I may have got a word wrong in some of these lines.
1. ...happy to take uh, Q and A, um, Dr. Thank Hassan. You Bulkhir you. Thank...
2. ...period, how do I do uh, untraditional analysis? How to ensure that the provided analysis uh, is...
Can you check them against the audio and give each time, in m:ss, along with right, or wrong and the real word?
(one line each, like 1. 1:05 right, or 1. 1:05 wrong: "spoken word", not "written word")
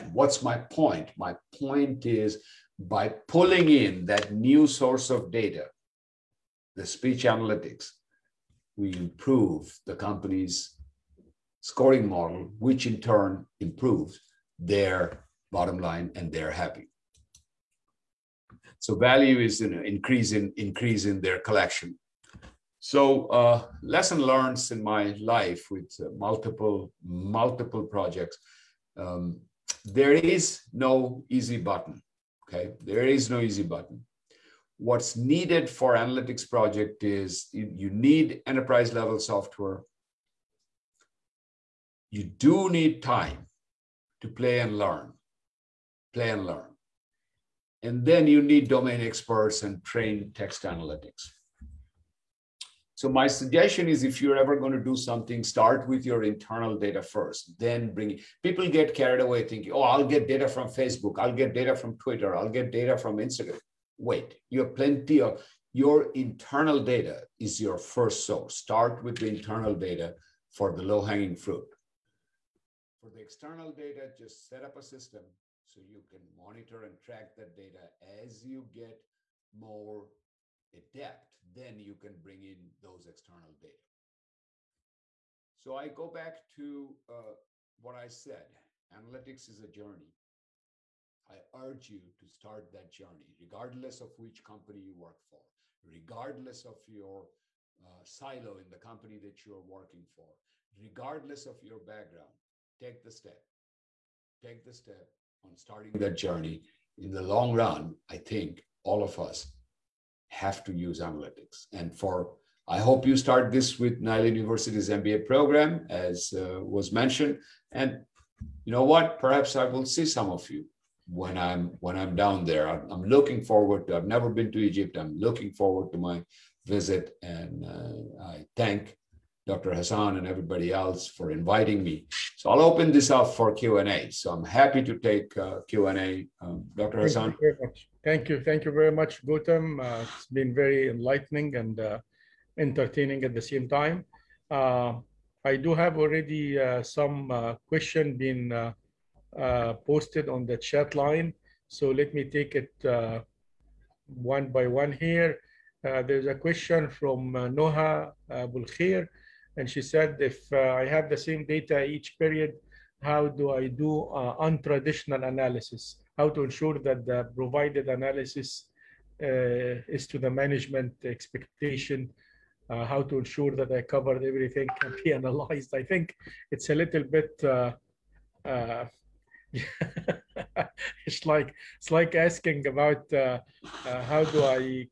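1. 2:14 wrong: "Thank", not "Bulkhir"
2. 2:42 right.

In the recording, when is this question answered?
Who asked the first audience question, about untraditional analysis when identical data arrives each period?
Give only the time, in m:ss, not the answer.
2:37.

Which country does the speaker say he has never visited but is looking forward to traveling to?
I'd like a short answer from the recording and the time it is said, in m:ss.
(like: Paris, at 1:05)
Egypt, at 2:04.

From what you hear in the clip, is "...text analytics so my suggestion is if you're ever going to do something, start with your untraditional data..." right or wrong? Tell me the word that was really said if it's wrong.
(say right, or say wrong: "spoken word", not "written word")
wrong: "internal", not "untraditional".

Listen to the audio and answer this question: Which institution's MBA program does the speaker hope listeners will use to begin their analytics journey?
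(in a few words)
Nile University.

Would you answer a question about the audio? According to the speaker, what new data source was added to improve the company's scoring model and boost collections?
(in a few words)
speech analytics.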